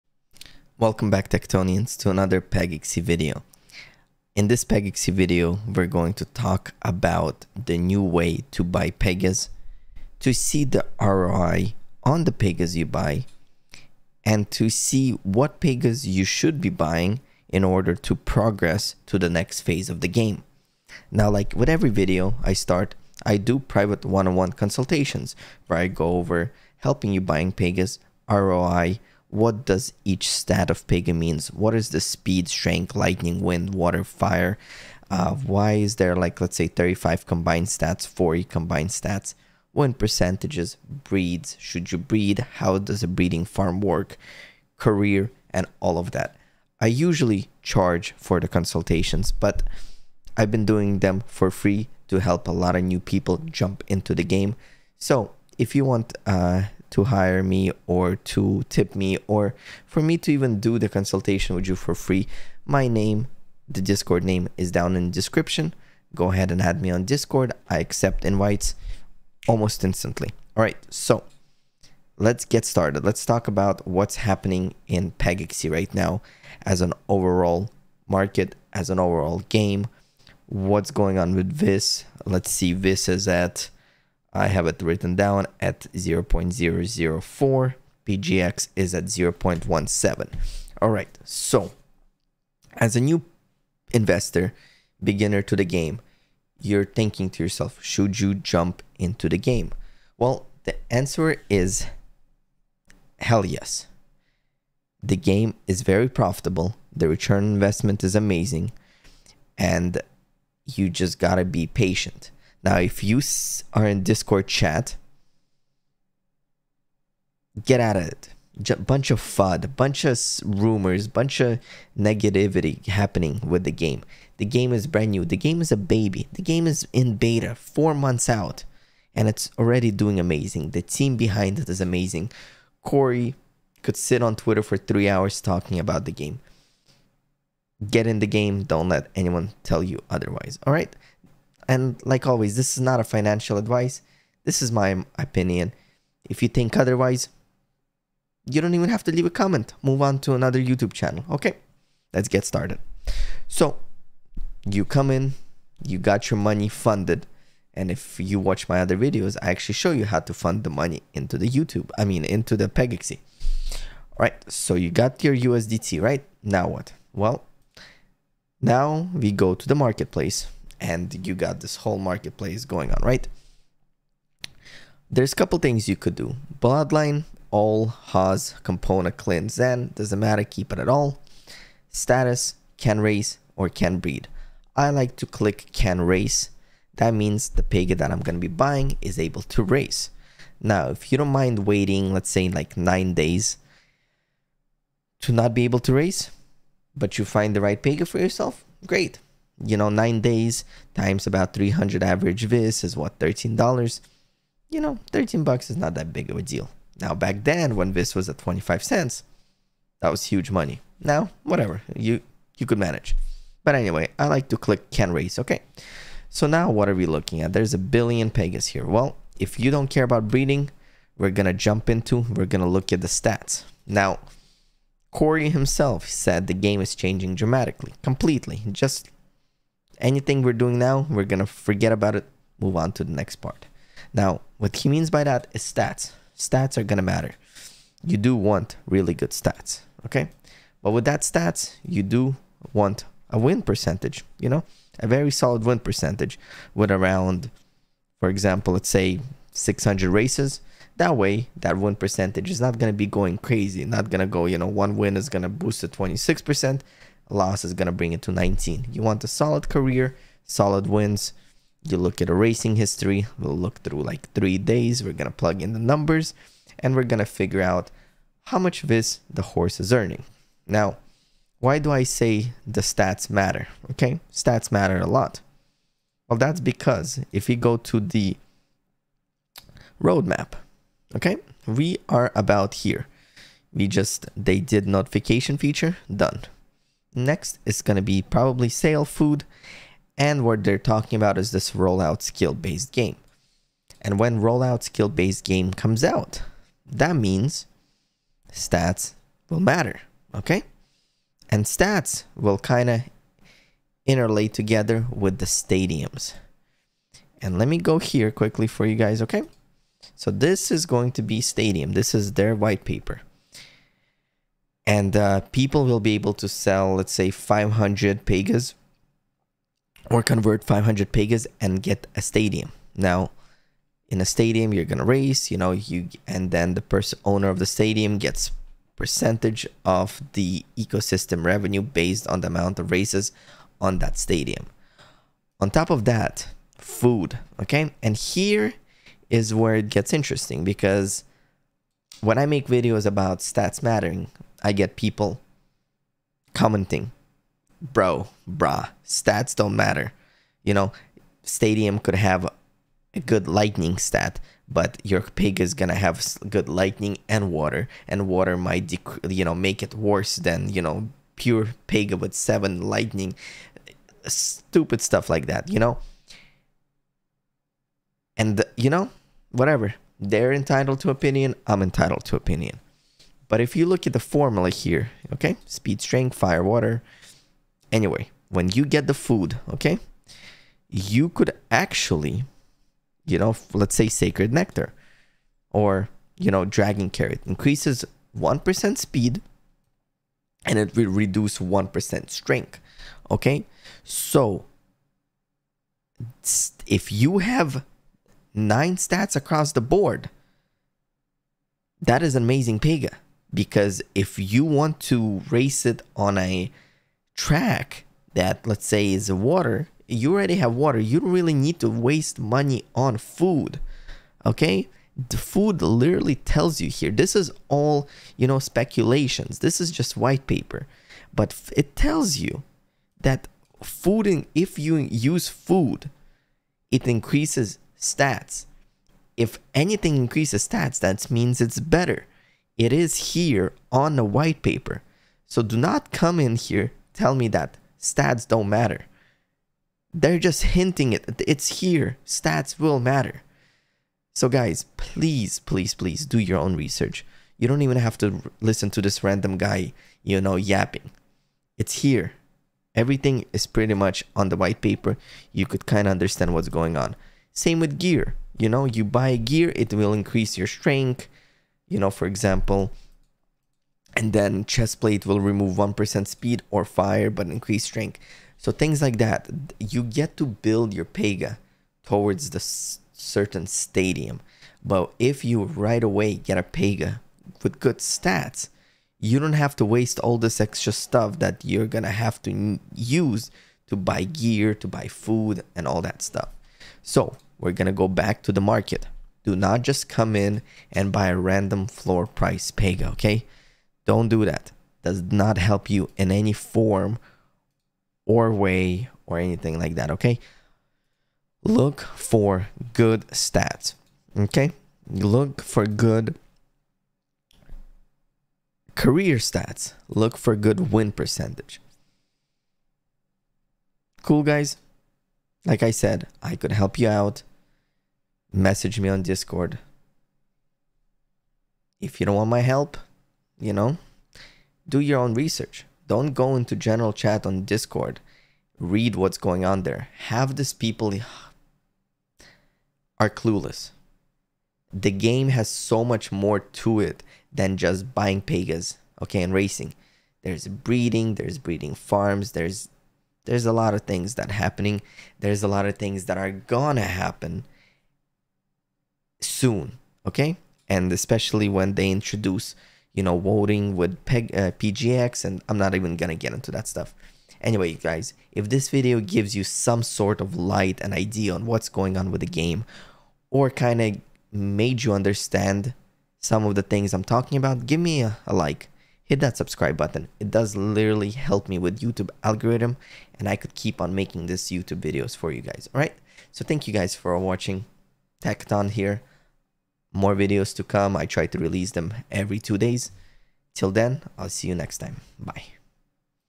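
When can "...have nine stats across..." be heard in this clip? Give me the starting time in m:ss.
6:37.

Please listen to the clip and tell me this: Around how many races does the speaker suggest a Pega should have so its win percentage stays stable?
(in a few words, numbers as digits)
600.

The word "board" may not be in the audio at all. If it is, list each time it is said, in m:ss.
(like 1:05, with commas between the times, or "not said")
6:39.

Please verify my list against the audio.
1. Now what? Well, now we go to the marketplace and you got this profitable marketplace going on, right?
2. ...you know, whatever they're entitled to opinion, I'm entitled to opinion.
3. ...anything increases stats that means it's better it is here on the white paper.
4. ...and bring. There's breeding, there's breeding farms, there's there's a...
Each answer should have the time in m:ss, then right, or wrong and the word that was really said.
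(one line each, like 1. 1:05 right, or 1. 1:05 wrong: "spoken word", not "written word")
1. 2:46 wrong: "whole", not "profitable"
2. 6:08 right
3. 7:09 right
4. 8:59 wrong: "racing", not "bring".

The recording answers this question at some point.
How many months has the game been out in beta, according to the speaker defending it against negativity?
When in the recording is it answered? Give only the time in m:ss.
2:07.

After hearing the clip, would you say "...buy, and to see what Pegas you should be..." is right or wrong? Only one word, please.
right.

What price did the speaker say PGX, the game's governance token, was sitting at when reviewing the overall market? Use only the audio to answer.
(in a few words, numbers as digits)
0.17.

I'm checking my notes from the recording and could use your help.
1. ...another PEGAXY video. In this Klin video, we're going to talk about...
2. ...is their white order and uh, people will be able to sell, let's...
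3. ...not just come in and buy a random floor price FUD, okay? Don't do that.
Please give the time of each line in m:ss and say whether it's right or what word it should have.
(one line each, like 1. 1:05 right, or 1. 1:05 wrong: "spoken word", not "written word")
1. 0:02 wrong: "PEGAXY", not "Klin"
2. 5:12 wrong: "paper", not "order"
3. 8:09 wrong: "Pega", not "FUD".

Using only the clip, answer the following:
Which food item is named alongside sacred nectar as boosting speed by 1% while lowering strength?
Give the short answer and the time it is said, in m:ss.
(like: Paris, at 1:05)
dragon carrot, at 6:26.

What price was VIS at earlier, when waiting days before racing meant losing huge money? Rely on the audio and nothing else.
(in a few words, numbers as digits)
25 cents.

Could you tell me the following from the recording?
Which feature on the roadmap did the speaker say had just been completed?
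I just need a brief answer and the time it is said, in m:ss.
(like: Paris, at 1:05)
notification feature, at 4:44.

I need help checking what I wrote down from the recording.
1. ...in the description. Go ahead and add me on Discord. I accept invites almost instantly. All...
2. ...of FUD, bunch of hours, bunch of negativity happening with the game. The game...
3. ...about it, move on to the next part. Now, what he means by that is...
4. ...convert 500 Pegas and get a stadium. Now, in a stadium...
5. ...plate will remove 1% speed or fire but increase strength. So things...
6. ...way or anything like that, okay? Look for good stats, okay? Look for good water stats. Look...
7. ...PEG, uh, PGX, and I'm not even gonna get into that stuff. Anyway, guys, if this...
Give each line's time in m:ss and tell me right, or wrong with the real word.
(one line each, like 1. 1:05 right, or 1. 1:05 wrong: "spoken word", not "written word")
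1. 1:04 right
2. 1:59 wrong: "rumors", not "hours"
3. 3:51 right
4. 5:20 right
5. 7:45 right
6. 8:18 wrong: "career", not "water"
7. 9:14 right.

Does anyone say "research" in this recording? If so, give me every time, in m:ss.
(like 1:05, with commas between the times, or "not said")
7:26, 8:45.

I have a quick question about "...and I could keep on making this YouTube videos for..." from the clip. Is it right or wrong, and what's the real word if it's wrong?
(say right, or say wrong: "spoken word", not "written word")
right.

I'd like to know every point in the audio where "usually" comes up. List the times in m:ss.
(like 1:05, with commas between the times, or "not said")
0:46.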